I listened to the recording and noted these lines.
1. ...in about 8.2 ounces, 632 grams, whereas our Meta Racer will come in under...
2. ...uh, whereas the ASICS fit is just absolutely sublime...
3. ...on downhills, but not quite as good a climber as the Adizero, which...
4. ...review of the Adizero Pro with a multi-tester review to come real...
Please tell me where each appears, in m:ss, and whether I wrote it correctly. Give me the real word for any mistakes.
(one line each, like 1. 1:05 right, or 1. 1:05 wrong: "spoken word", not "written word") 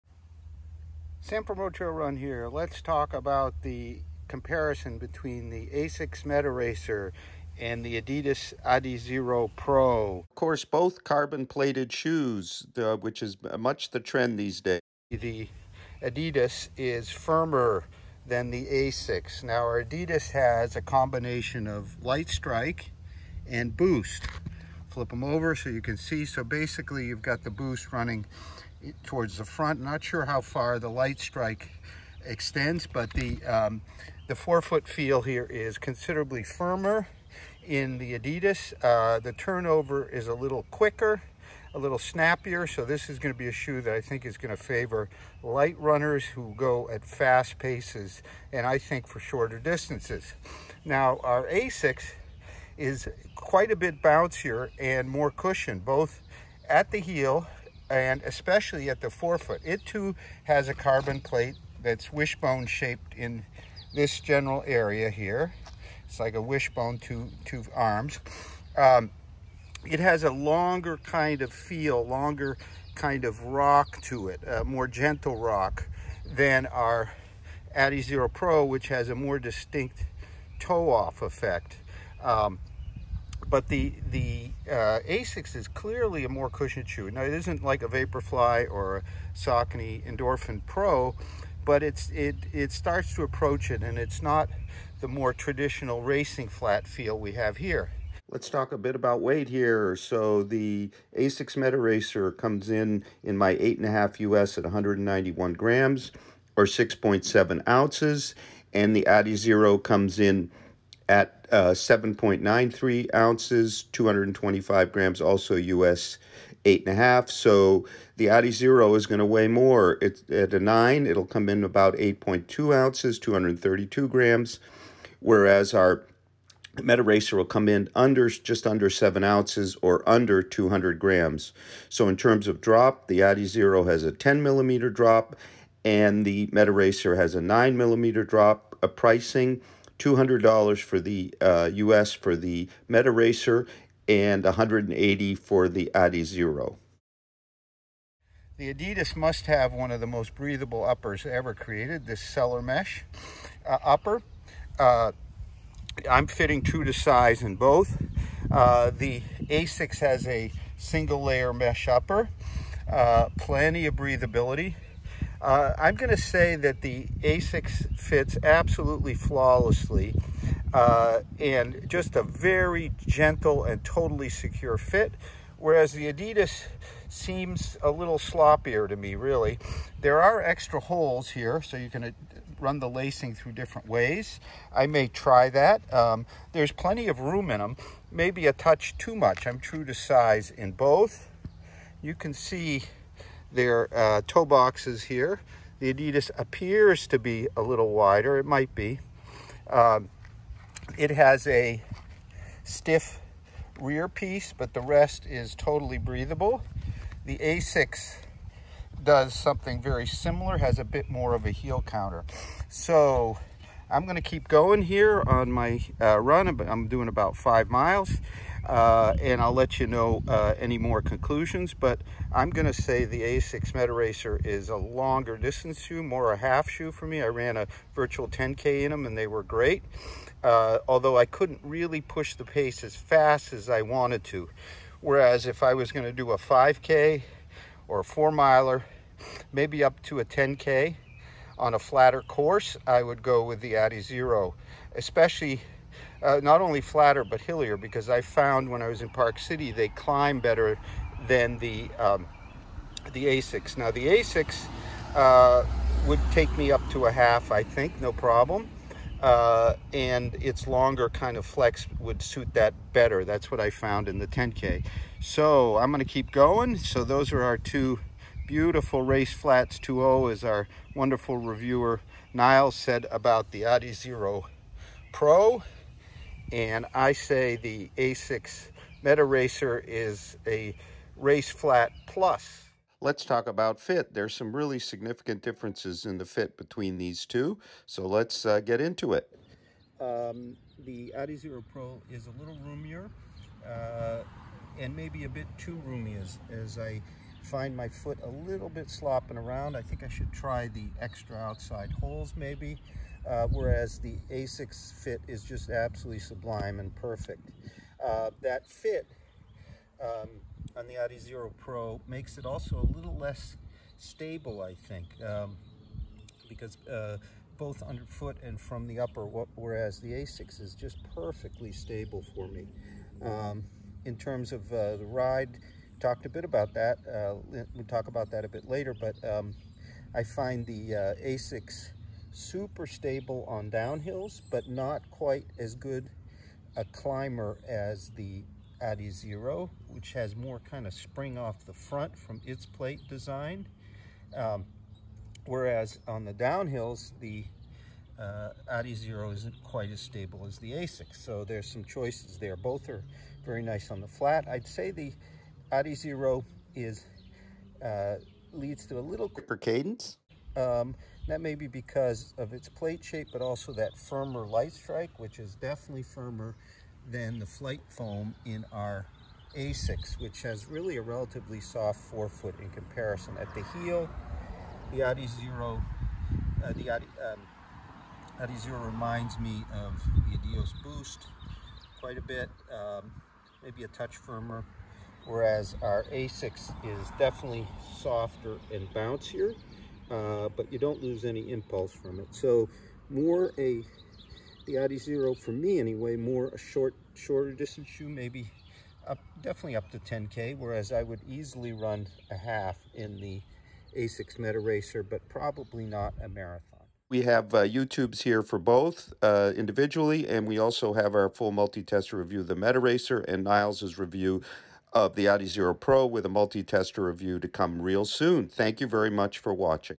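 1. 2:01 wrong: "232", not "632"
2. 5:03 right
3. 5:33 right
4. 6:53 right.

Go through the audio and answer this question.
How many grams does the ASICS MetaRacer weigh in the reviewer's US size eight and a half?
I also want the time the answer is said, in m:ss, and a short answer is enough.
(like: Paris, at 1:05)
191 grams, at 1:44.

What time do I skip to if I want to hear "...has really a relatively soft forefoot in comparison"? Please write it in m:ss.
6:10.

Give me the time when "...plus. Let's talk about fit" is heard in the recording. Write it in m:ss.
4:42.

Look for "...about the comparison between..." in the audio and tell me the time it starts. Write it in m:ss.
0:03.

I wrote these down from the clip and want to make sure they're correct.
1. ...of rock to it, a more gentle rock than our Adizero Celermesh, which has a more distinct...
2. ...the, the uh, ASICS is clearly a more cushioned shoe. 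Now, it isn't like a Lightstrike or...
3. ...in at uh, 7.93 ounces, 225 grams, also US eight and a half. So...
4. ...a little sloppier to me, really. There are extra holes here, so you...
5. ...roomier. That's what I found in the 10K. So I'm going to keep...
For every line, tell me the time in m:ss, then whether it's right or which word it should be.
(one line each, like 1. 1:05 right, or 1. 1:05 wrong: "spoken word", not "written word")
1. 1:13 wrong: "Pro", not "Celermesh"
2. 1:23 wrong: "Vaporfly", not "Lightstrike"
3. 1:50 right
4. 2:57 right
5. 4:22 wrong: "better", not "roomier".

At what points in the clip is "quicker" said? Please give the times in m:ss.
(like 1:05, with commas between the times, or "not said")
0:40, 5:59.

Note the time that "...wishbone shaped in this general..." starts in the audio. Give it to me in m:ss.
1:02.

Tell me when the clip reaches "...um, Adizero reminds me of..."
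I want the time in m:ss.
6:17.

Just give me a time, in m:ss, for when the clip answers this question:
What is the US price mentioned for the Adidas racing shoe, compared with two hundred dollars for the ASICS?
2:24.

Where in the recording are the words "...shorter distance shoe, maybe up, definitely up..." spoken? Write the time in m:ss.
6:37.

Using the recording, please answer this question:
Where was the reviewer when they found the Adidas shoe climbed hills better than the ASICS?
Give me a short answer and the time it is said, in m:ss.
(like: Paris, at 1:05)
Park City, at 4:09.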